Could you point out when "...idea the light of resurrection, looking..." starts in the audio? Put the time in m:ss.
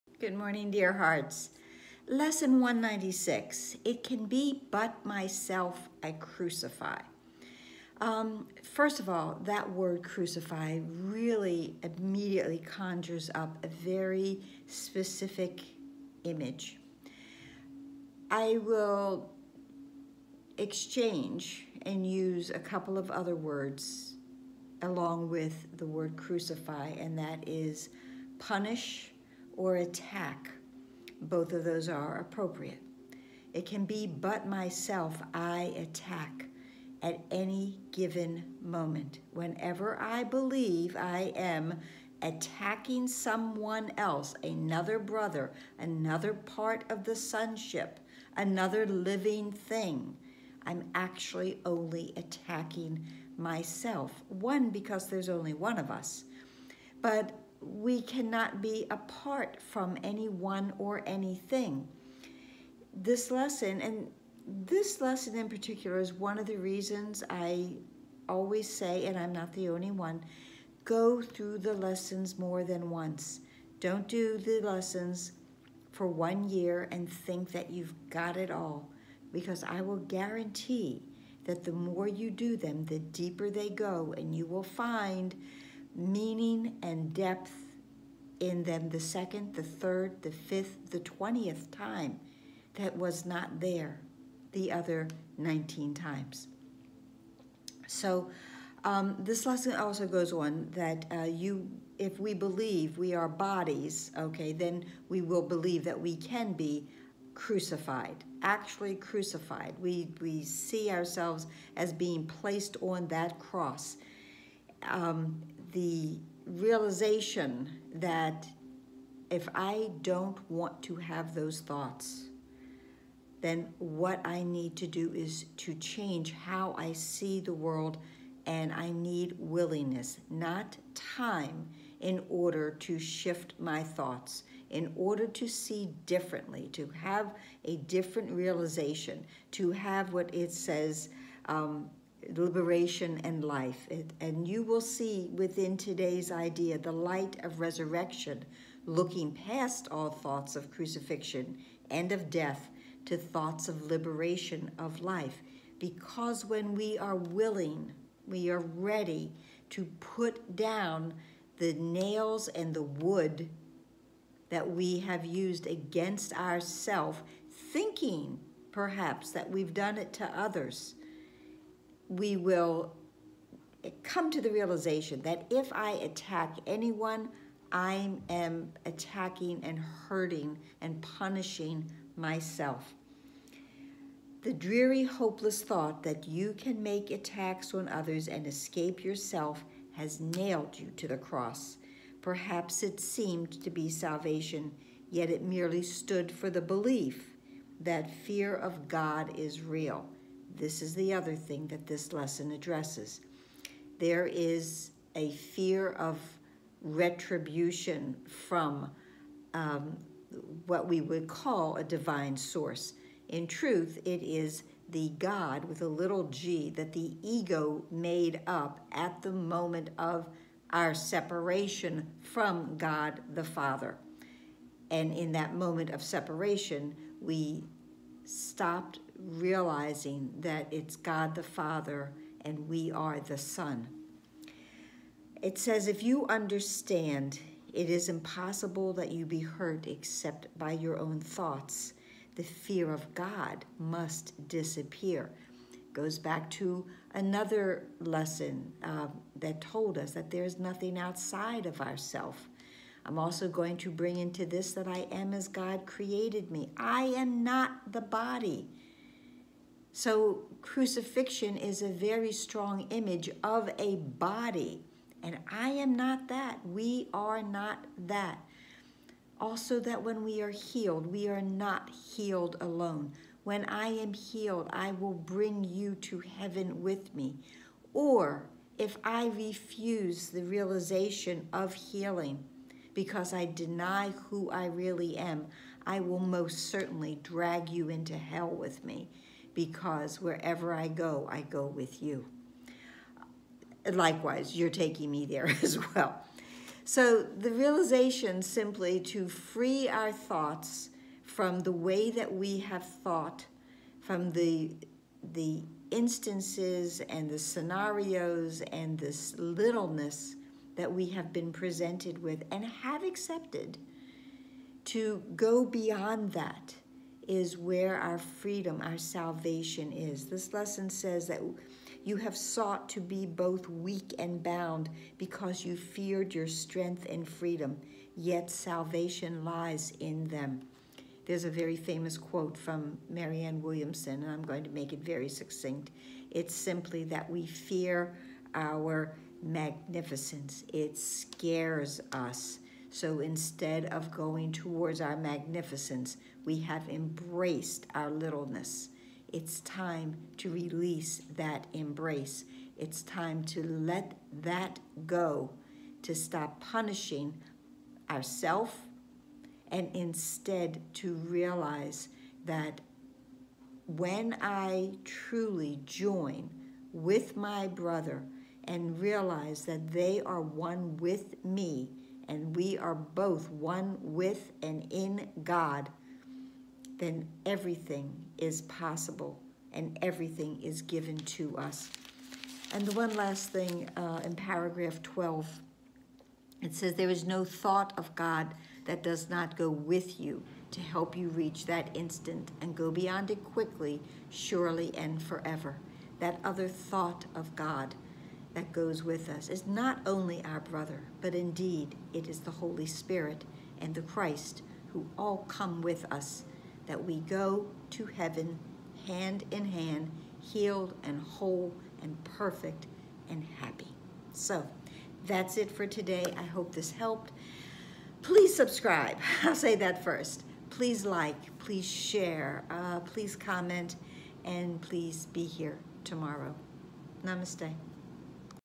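2:26.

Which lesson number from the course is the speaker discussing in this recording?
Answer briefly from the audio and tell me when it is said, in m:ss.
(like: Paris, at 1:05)
196, at 0:02.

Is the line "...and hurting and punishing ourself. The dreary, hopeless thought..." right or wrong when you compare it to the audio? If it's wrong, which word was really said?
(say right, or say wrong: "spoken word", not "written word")
wrong: "myself", not "ourself".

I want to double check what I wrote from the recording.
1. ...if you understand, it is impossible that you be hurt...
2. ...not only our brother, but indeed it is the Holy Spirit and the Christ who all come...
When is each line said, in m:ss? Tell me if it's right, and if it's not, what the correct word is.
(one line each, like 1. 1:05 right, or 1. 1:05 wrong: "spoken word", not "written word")
1. 3:55 right
2. 6:39 right.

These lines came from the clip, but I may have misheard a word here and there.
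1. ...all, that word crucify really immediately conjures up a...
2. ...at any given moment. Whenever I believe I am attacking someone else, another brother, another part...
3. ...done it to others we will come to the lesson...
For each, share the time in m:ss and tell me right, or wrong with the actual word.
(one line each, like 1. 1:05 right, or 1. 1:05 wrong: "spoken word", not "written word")
1. 0:09 right
2. 0:37 right
3. 2:49 wrong: "realization", not "lesson".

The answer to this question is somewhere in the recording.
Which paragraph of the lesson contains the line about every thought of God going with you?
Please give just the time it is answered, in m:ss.
6:24.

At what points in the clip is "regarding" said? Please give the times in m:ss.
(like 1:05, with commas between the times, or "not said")
not said.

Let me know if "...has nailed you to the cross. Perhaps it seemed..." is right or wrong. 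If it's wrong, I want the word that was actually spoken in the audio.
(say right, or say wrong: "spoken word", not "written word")
right.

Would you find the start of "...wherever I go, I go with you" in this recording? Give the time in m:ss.
4:50.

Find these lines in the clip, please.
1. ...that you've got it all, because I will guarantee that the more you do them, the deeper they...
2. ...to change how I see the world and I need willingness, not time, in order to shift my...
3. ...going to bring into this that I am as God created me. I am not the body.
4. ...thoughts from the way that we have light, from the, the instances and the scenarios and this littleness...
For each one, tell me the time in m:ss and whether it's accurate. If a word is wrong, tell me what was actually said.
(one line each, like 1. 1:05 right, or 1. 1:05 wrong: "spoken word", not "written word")
1. 1:17 right
2. 2:05 right
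3. 4:13 right
4. 5:00 wrong: "thought", not "light".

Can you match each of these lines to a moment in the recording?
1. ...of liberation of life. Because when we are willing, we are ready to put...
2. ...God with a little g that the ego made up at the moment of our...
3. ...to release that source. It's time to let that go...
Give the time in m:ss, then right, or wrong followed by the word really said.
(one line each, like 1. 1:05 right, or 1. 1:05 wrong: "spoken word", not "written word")
1. 2:33 right
2. 3:35 right
3. 5:50 wrong: "embrace", not "source".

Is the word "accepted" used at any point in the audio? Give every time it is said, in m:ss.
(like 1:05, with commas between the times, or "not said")
5:13.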